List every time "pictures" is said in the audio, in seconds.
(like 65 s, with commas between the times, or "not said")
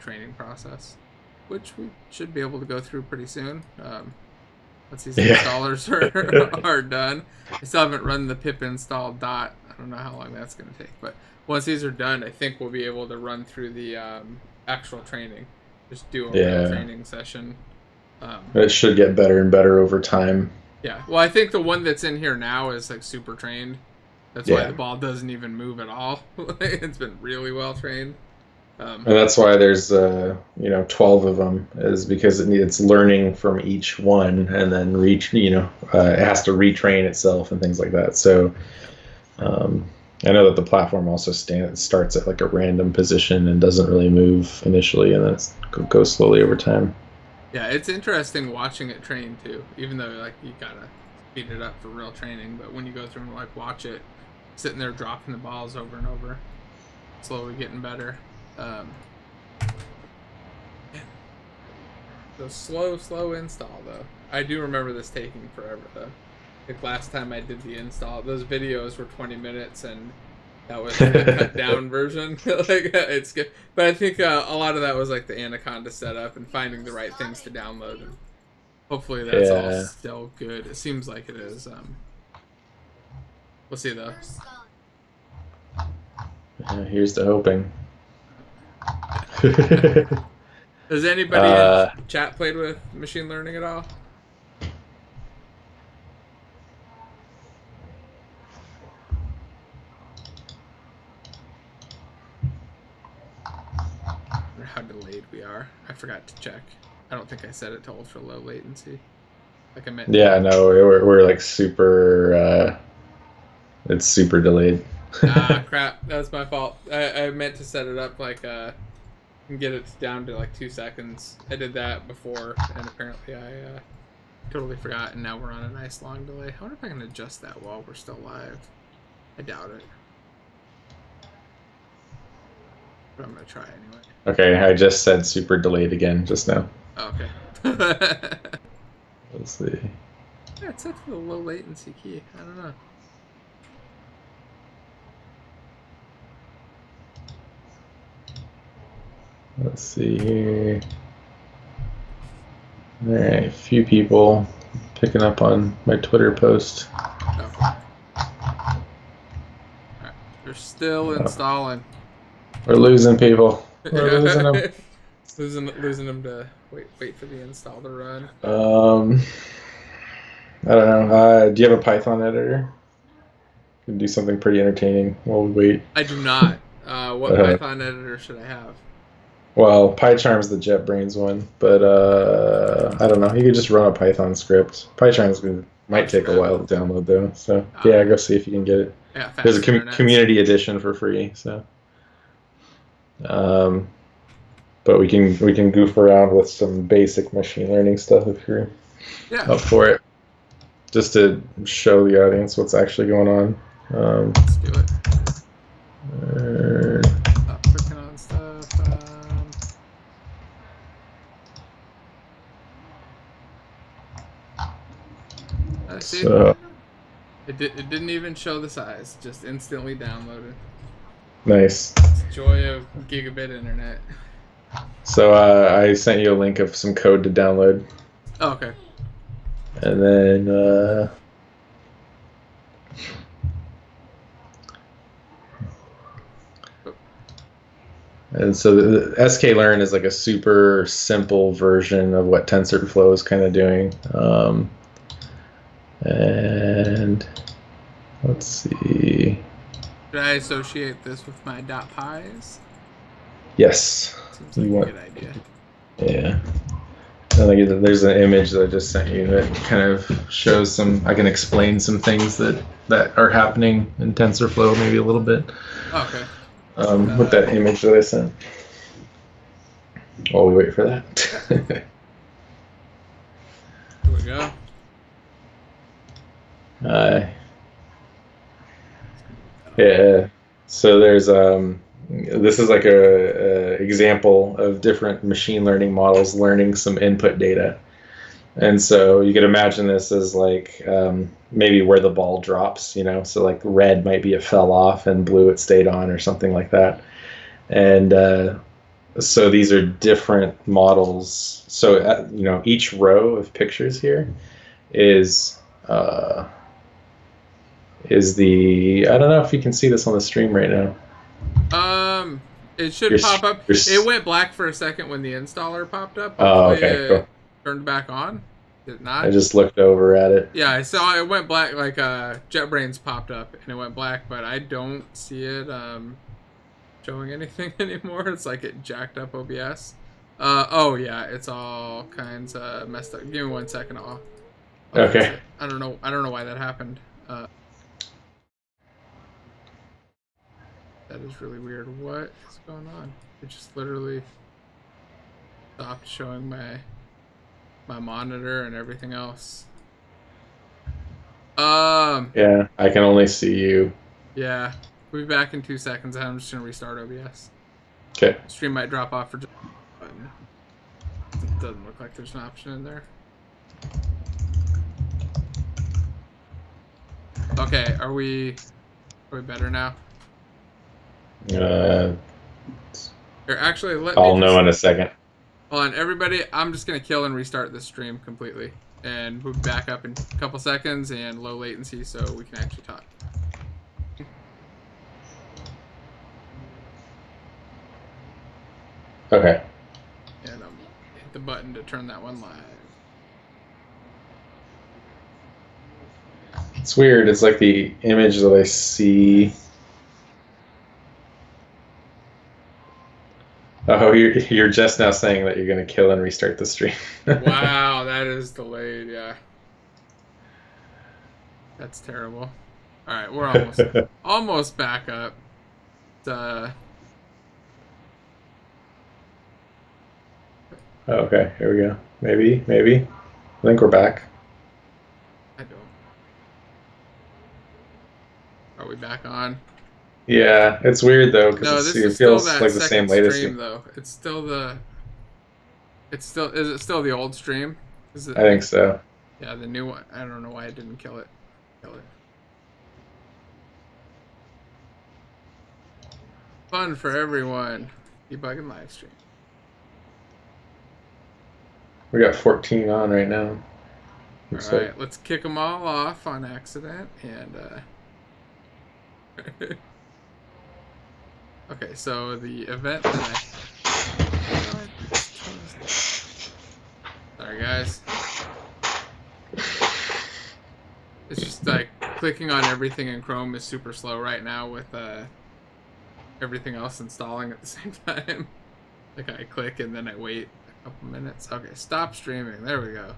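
303 s.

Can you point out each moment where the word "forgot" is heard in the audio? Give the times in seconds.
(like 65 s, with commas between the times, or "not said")
105 s, 124 s.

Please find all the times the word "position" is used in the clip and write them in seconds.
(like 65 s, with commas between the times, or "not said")
42 s.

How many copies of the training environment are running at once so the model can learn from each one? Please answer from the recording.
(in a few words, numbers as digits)
12.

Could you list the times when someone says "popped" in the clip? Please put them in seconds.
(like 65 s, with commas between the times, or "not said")
315 s, 323 s.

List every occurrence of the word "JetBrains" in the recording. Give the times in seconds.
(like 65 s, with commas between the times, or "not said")
180 s, 322 s.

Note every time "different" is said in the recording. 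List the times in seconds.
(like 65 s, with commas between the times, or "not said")
284 s, 299 s.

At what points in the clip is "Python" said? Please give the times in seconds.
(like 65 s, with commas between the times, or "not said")
171 s, 177 s, 183 s.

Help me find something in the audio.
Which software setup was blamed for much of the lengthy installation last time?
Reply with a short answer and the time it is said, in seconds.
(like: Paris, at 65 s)
Anaconda, at 75 s.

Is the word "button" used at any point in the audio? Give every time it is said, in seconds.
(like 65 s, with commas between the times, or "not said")
391 s.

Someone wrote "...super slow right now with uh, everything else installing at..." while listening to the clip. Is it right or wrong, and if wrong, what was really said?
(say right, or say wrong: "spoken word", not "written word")
right.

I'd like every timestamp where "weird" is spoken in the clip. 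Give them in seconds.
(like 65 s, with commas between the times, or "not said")
341 s, 396 s, 431 s.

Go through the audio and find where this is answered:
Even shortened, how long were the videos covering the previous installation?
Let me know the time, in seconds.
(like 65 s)
69 s.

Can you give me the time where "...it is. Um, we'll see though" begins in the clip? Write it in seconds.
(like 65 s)
81 s.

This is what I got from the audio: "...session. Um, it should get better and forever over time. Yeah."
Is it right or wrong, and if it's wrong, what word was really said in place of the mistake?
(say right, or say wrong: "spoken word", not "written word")
wrong: "better", not "forever".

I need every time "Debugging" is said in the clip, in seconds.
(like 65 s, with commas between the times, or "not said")
448 s.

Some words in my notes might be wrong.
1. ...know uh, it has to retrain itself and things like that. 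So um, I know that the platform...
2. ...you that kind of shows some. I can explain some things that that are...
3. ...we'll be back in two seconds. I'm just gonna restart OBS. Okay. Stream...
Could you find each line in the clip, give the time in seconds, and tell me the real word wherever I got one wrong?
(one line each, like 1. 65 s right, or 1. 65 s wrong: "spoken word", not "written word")
1. 35 s right
2. 259 s right
3. 355 s right.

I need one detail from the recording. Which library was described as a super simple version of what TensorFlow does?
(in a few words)
sklearn.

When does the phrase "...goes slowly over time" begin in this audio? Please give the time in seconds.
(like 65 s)
45 s.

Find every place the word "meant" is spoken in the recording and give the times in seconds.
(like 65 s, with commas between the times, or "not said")
109 s, 117 s.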